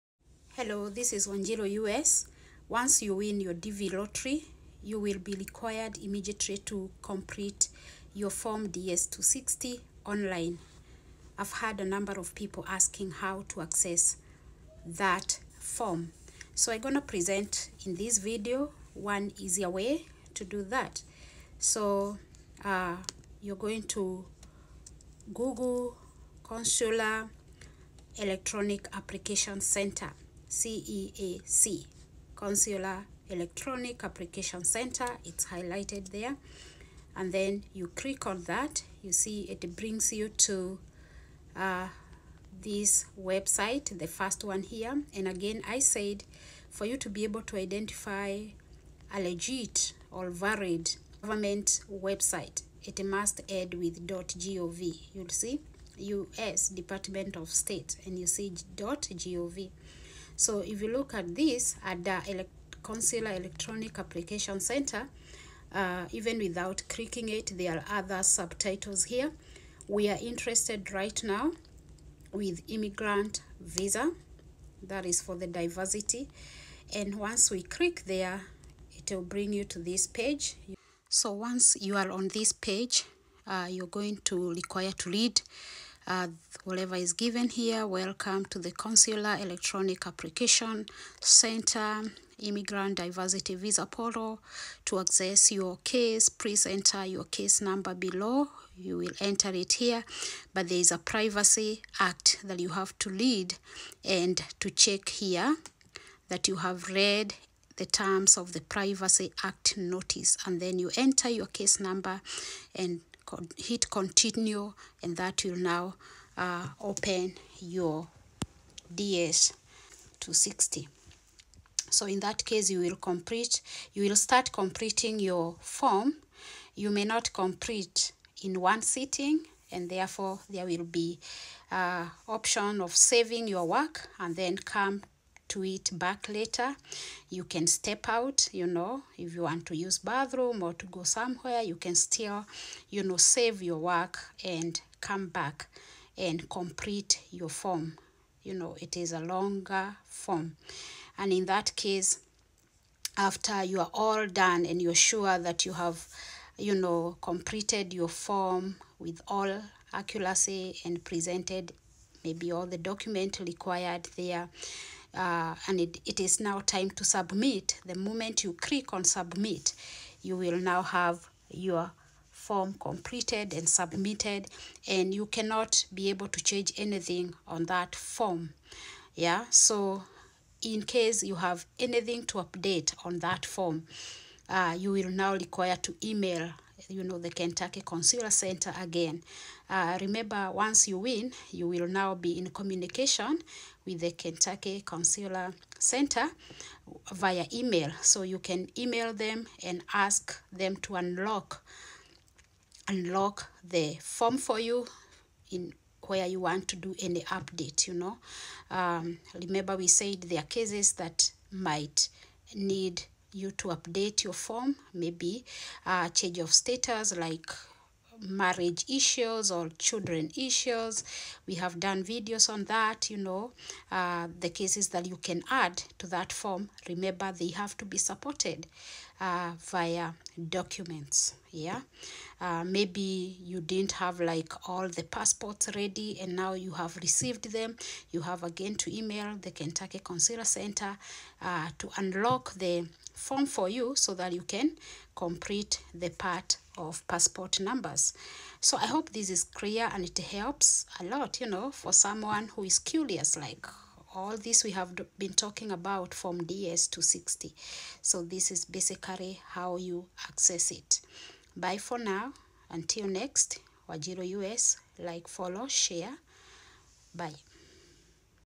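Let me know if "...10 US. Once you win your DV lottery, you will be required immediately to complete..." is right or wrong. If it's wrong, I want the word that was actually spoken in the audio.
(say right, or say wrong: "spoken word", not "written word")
right.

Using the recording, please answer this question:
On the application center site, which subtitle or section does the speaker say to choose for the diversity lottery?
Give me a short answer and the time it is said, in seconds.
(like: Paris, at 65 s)
Immigrant visa, at 72 s.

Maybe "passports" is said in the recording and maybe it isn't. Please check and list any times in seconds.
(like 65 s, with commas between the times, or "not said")
235 s, 247 s.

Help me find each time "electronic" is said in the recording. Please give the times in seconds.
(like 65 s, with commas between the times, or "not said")
28 s, 33 s, 63 s, 89 s.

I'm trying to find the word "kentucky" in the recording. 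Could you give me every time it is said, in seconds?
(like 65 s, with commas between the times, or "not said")
187 s, 194 s, 239 s.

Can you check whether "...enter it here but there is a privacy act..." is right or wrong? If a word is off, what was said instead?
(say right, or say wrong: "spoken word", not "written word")
right.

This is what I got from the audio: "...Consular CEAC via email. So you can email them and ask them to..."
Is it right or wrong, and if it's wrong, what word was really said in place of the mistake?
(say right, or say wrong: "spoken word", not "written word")
wrong: "Center", not "CEAC".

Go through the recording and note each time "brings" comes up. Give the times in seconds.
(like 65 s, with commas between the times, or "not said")
39 s, 79 s.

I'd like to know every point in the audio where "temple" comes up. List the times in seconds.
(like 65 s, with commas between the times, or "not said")
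not said.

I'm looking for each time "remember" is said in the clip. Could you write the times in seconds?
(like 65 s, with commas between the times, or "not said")
190 s, 209 s, 226 s.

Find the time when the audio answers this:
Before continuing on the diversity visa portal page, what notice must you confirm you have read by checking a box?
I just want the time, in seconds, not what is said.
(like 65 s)
108 s.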